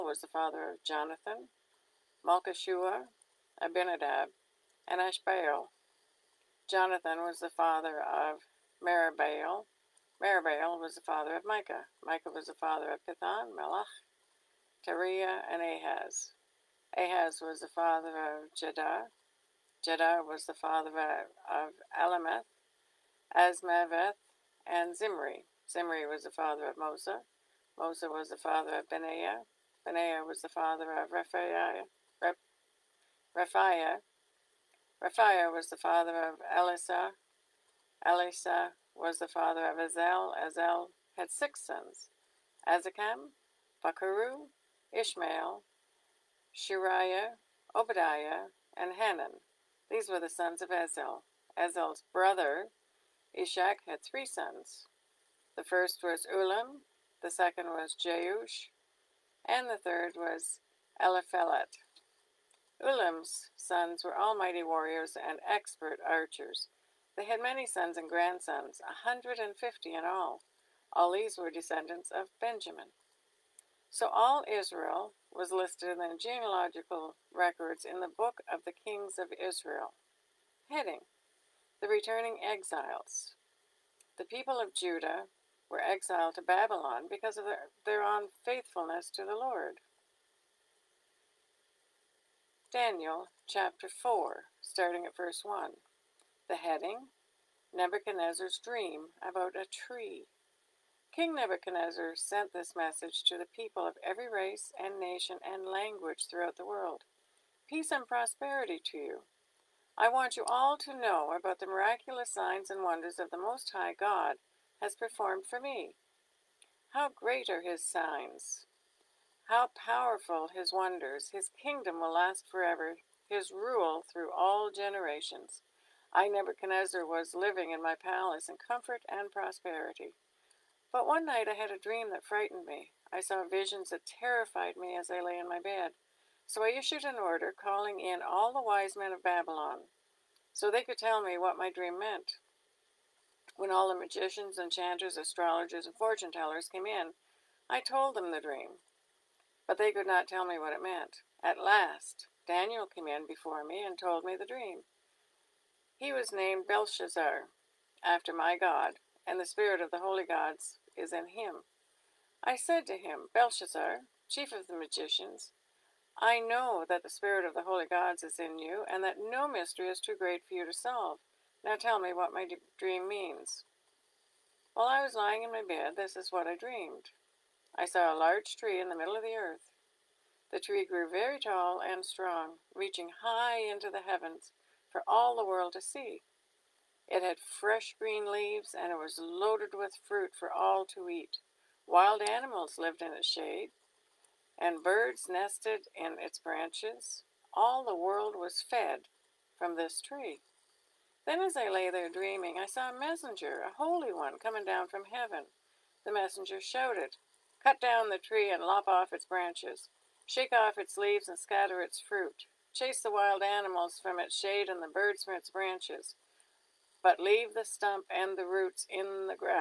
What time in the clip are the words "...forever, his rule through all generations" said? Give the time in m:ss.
2:02.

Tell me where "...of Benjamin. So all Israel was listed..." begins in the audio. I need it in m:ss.
1:12.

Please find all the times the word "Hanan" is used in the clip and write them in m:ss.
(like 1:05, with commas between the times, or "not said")
0:48.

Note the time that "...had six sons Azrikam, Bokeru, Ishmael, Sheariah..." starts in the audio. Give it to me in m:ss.
0:41.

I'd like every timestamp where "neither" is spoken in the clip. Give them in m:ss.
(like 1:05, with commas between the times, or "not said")
not said.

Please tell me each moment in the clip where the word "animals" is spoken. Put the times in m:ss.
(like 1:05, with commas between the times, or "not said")
3:12, 3:33.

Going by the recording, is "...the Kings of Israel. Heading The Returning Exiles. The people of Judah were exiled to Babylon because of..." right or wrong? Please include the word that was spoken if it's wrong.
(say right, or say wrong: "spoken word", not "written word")
right.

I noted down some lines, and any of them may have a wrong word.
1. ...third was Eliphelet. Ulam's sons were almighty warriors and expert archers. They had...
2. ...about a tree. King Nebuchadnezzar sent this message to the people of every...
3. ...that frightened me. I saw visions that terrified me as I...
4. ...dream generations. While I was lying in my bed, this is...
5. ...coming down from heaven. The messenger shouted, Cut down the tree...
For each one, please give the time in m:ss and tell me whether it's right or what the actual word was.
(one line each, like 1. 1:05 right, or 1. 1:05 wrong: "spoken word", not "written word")
1. 0:59 right
2. 1:39 right
3. 2:12 right
4. 2:52 wrong: "means", not "generations"
5. 3:24 right.